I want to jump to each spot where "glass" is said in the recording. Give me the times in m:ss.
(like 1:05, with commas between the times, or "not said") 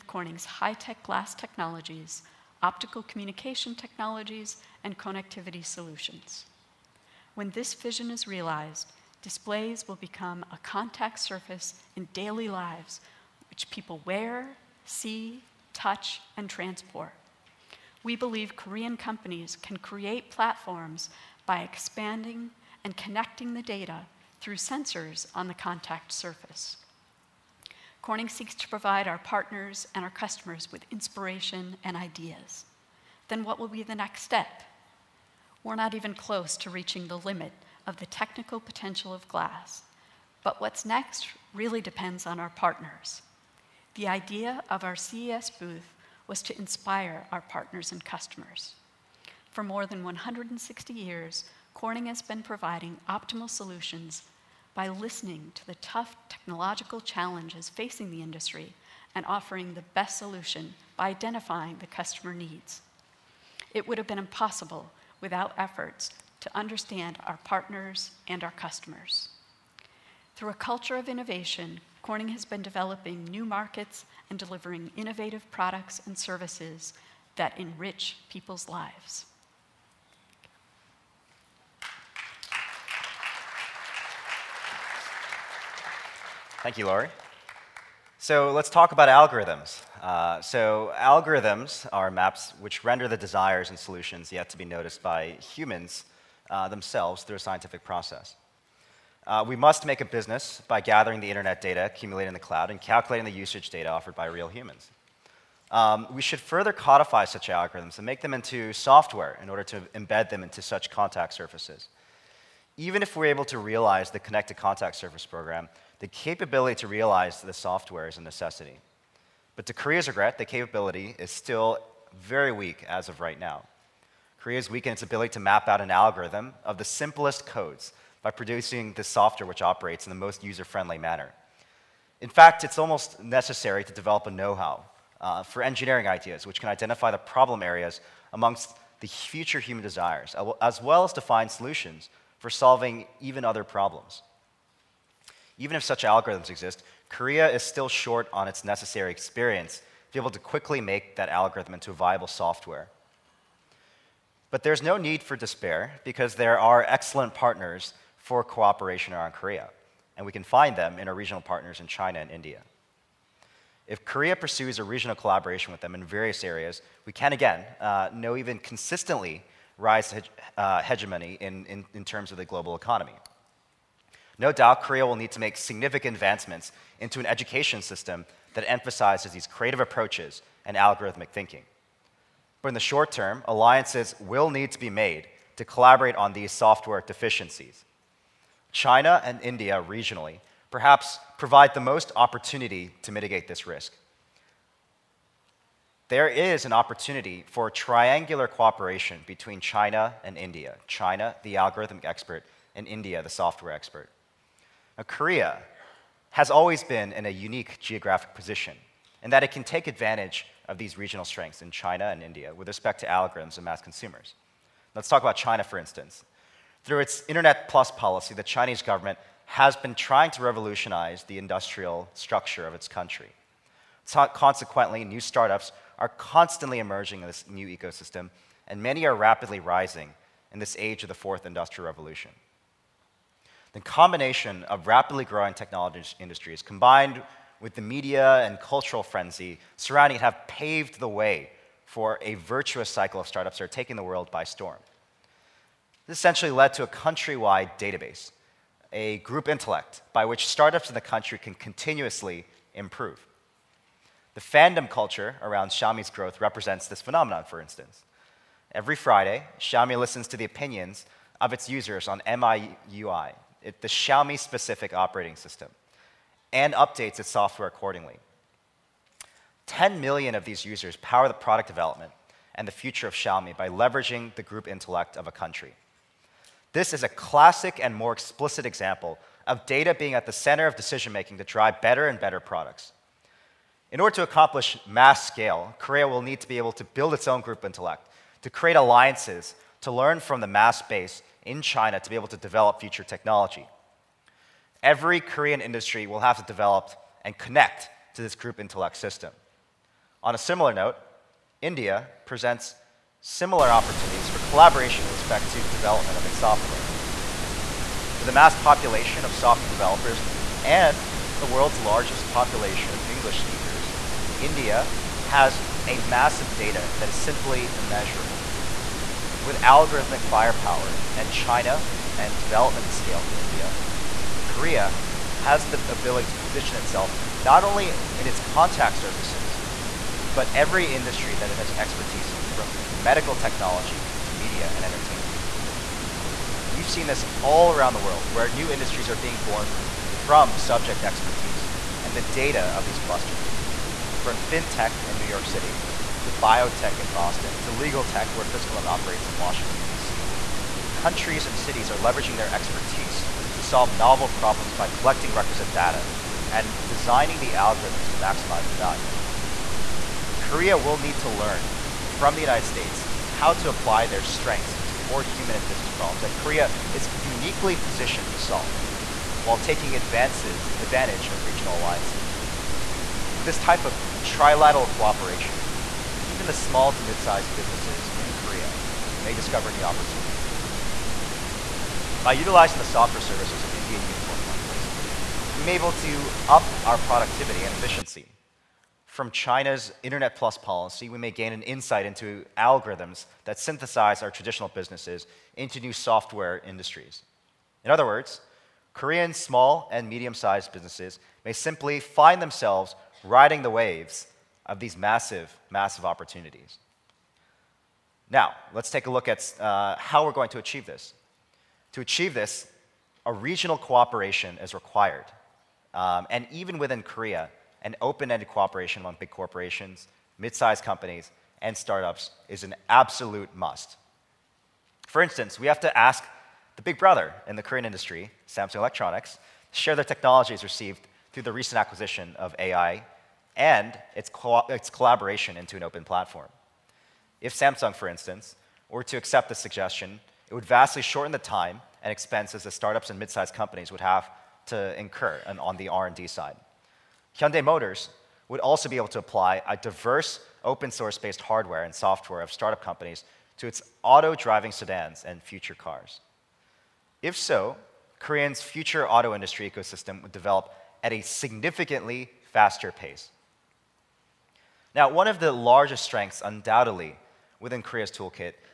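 0:01, 0:39.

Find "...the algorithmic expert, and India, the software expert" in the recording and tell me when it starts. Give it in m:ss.
3:21.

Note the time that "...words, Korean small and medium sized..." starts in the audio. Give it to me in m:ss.
6:38.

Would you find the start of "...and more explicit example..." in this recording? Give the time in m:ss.
4:37.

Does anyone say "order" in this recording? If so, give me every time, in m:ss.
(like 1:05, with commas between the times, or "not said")
1:49, 4:43.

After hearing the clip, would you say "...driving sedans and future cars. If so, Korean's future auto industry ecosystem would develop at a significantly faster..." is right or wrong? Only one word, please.
right.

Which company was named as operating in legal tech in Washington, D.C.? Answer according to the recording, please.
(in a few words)
FiscalNote.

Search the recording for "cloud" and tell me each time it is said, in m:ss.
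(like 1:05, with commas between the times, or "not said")
1:42.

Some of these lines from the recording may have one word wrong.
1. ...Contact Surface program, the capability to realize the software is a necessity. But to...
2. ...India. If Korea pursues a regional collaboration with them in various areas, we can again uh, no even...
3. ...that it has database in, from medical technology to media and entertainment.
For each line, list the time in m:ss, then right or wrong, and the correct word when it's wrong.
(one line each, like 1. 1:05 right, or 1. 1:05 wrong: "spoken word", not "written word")
1. 1:54 right
2. 2:42 right
3. 5:31 wrong: "expertise", not "database".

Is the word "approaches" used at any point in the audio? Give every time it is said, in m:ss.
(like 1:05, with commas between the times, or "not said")
2:59.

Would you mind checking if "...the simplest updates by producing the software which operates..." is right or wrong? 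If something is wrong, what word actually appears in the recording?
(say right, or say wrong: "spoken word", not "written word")
wrong: "codes", not "updates".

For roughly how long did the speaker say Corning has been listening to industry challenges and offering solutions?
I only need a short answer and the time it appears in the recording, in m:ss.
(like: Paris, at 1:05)
160 years, at 0:50.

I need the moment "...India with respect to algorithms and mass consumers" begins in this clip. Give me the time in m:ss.
3:32.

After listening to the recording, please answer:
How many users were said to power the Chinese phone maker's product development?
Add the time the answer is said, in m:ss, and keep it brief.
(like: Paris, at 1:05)
10 million, at 4:29.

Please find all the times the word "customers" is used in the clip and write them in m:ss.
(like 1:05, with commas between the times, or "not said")
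0:30, 0:48, 1:01, 1:08.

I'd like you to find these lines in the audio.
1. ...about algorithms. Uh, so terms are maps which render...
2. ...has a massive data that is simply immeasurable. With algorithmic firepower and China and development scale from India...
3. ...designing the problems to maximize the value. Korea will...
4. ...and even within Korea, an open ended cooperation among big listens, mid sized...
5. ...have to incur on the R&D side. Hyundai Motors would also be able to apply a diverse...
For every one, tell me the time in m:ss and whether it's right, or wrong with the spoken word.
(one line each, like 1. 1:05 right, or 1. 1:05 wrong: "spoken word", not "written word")
1. 1:28 wrong: "algorithms", not "terms"
2. 5:15 right
3. 5:56 wrong: "algorithms", not "problems"
4. 6:56 wrong: "corporations", not "listens"
5. 7:24 right.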